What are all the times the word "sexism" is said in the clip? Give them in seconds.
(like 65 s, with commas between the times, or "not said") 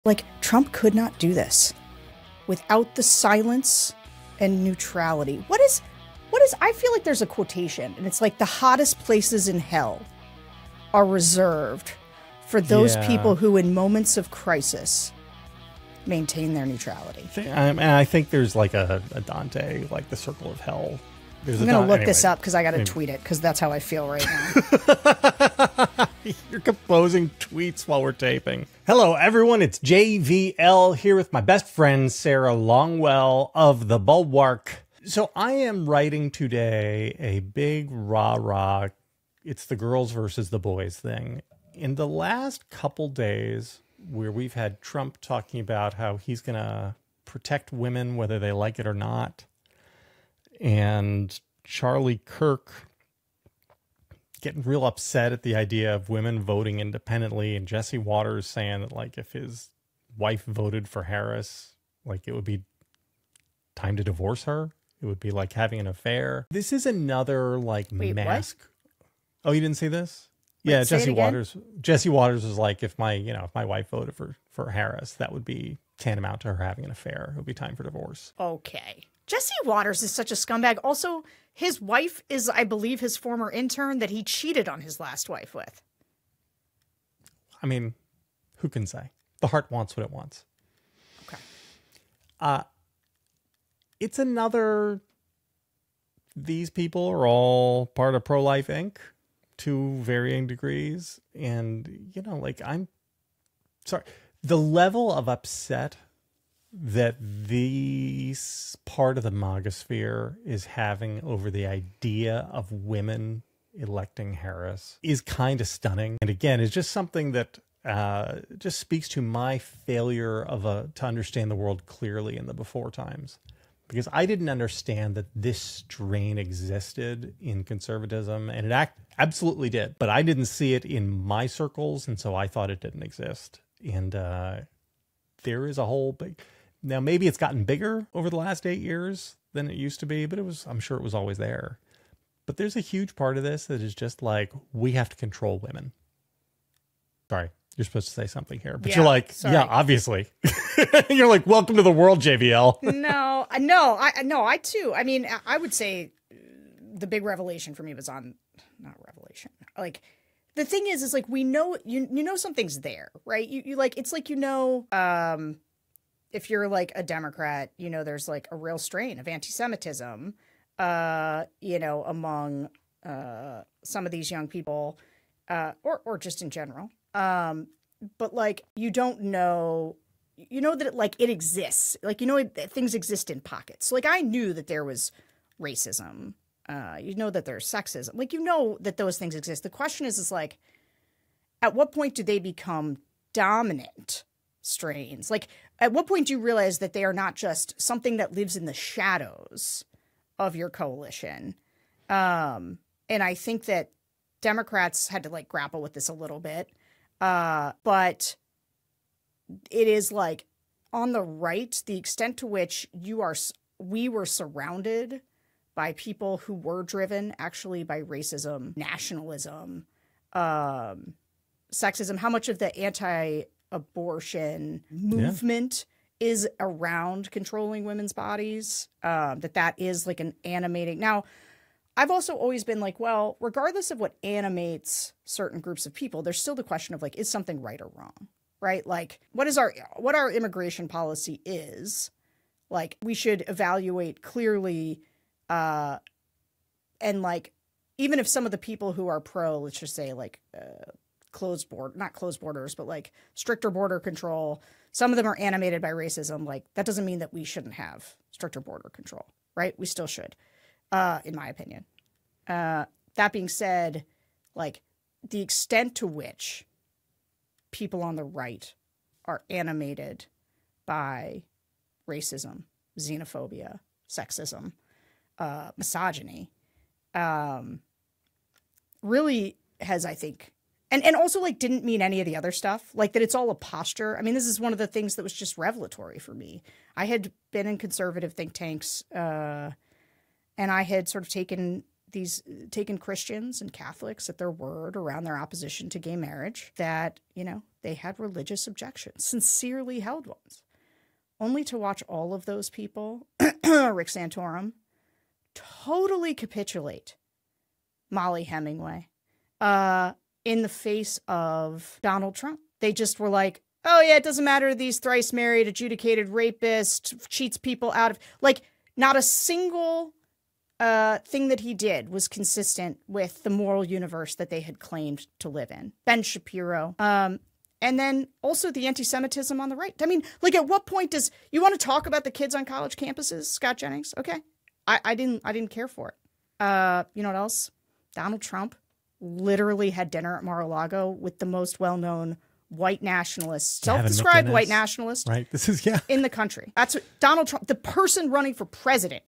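187 s, 221 s, 274 s.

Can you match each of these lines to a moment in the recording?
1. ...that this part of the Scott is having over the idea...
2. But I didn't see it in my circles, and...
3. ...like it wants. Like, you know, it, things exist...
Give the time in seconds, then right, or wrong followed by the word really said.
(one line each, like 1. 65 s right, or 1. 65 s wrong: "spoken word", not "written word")
1. 106 s wrong: "MAGAsphere", not "Scott"
2. 129 s right
3. 180 s wrong: "exists", not "wants".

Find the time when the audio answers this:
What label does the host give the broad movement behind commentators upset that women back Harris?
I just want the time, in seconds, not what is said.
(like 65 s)
98 s.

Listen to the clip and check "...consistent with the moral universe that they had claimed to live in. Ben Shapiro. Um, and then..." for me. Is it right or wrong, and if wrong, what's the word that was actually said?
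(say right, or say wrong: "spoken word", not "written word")
right.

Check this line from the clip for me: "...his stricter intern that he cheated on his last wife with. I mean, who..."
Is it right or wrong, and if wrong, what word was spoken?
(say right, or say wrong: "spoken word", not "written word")
wrong: "former", not "stricter".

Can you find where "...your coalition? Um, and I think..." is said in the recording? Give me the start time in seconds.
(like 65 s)
200 s.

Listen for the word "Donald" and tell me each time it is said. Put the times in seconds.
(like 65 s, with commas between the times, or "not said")
312 s, 338 s, 347 s.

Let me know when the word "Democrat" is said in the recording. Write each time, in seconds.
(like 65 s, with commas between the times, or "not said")
167 s, 204 s.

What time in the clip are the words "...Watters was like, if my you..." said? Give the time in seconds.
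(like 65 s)
72 s.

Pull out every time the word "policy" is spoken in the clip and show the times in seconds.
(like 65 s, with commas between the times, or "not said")
240 s.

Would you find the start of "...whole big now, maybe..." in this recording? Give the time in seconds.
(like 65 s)
135 s.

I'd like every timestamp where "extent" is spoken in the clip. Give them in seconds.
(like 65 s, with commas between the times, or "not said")
211 s, 265 s.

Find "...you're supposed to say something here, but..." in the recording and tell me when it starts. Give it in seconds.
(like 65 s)
147 s.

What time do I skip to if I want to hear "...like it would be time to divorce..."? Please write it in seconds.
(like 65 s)
62 s.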